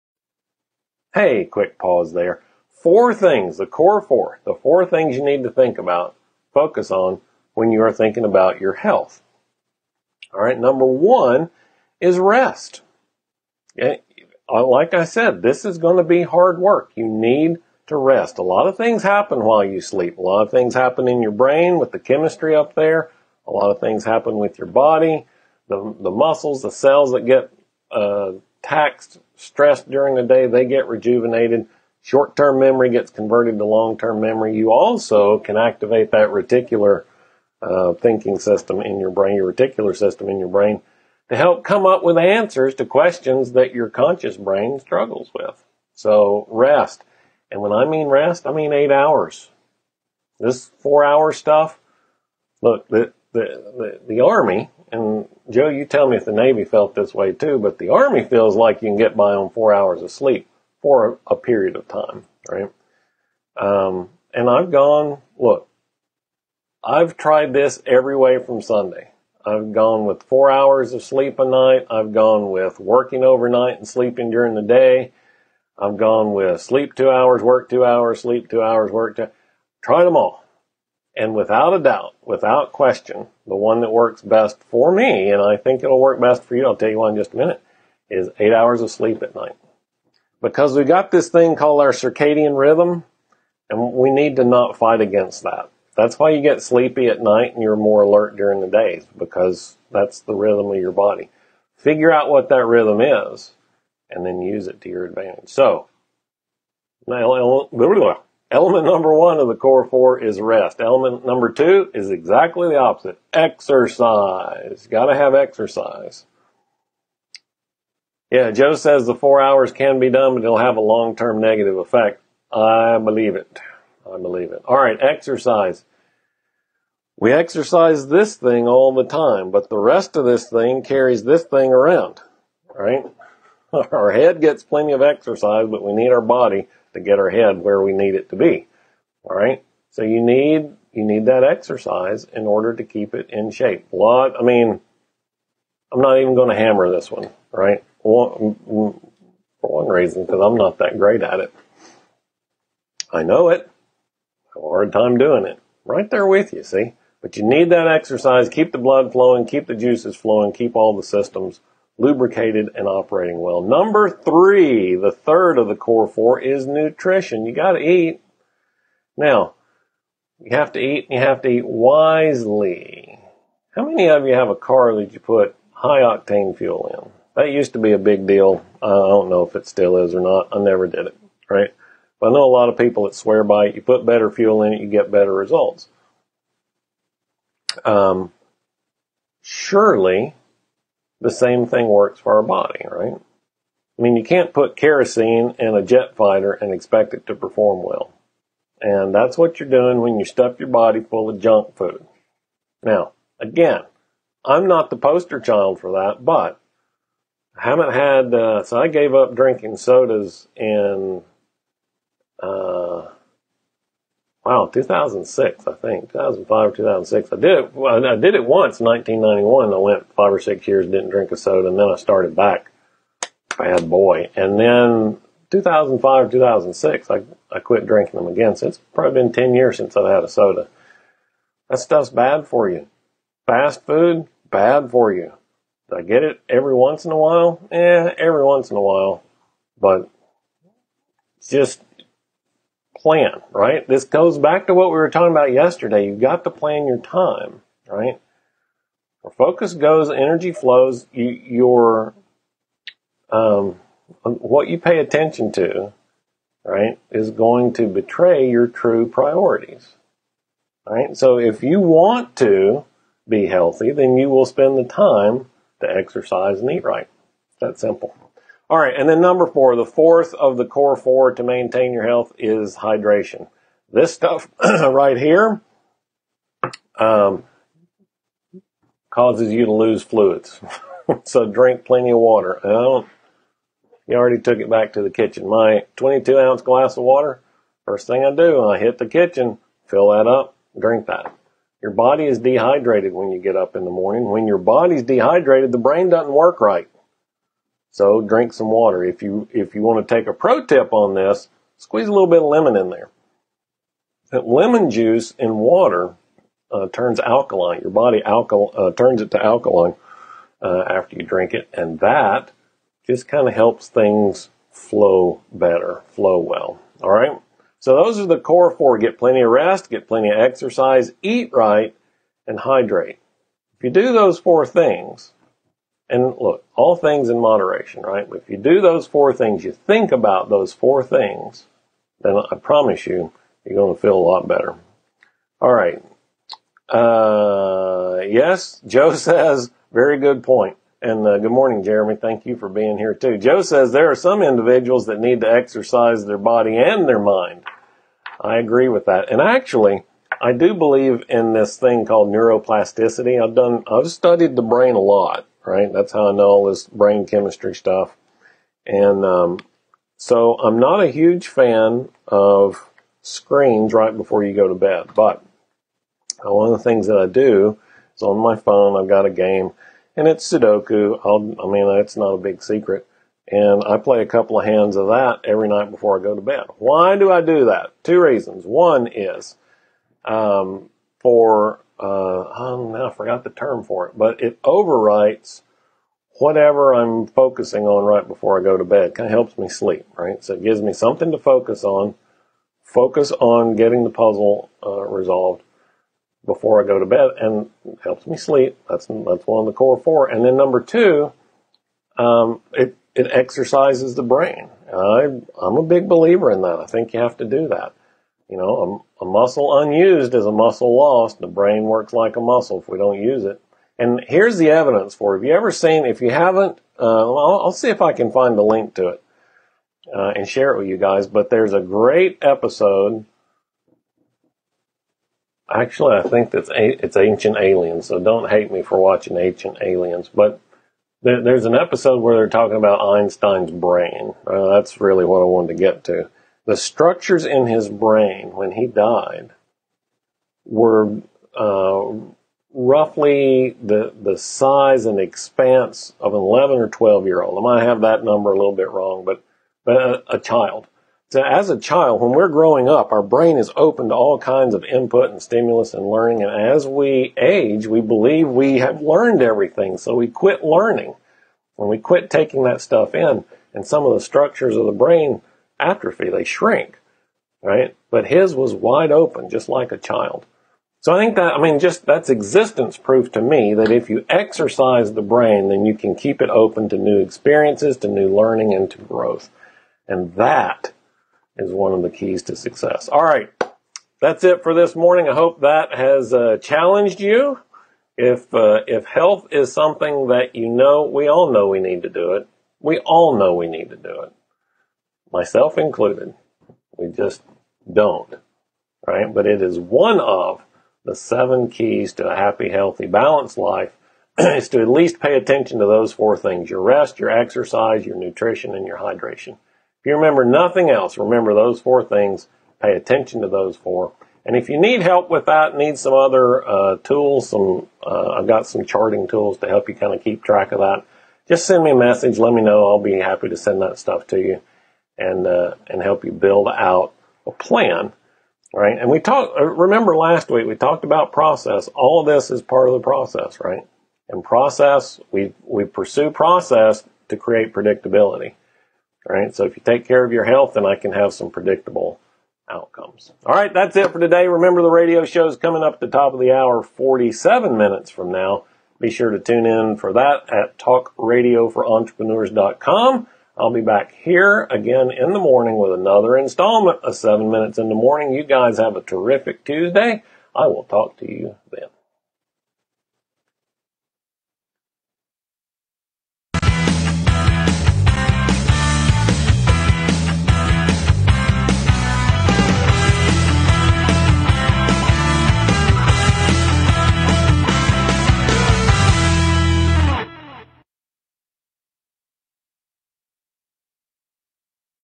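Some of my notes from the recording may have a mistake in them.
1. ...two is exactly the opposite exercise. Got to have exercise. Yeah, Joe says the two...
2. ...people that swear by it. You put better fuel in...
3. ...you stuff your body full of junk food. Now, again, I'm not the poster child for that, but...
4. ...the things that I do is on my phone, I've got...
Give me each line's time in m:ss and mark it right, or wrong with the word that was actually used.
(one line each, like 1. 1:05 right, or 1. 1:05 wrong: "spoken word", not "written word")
1. 1:51 wrong: "four", not "two"
2. 3:02 right
3. 3:20 right
4. 6:06 right.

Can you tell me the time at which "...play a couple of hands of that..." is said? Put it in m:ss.
6:13.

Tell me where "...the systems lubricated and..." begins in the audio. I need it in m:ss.
2:40.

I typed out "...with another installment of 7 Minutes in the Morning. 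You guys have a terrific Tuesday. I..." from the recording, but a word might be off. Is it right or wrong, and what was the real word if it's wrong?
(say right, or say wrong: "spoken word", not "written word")
right.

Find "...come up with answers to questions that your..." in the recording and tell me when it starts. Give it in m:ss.
0:41.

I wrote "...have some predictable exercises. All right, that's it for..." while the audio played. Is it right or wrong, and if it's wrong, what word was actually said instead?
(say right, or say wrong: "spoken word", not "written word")
wrong: "outcomes", not "exercises".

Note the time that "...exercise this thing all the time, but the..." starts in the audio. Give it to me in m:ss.
2:07.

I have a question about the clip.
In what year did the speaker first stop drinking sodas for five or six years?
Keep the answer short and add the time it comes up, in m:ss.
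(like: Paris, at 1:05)
1991, at 3:38.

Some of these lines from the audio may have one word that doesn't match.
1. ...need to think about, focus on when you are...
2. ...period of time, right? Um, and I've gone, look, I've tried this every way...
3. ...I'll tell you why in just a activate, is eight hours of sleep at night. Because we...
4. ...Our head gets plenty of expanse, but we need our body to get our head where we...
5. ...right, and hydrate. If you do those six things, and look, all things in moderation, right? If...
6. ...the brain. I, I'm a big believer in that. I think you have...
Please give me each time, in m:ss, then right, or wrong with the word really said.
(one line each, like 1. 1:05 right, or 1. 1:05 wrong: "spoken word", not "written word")
1. 0:05 right
2. 1:01 right
3. 1:26 wrong: "minute", not "activate"
4. 2:13 wrong: "exercise", not "expanse"
5. 5:21 wrong: "four", not "six"
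6. 6:44 right.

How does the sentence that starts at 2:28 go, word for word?
for one reason, because I'm not that great at it.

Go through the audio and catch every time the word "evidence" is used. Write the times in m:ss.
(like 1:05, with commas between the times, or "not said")
6:54.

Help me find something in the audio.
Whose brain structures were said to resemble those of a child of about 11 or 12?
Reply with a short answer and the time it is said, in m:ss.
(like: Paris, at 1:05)
Einstein, at 7:12.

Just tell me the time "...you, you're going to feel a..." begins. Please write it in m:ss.
5:33.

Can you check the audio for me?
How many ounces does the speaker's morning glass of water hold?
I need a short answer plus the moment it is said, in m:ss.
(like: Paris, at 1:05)
22, at 4:45.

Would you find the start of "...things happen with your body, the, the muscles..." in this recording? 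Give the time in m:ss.
0:23.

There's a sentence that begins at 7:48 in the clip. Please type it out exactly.
But his was wide open, just like a child.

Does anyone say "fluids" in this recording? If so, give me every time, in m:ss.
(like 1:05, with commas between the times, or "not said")
4:40.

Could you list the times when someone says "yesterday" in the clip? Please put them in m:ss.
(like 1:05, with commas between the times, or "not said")
4:05.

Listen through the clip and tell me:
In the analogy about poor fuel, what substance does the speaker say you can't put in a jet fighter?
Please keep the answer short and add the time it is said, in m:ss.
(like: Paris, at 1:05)
kerosene, at 3:14.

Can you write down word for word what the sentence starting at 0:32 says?
Short term memory gets converted to long term memory.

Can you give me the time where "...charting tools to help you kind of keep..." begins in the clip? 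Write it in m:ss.
8:38.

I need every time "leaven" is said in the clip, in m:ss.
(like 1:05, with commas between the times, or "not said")
not said.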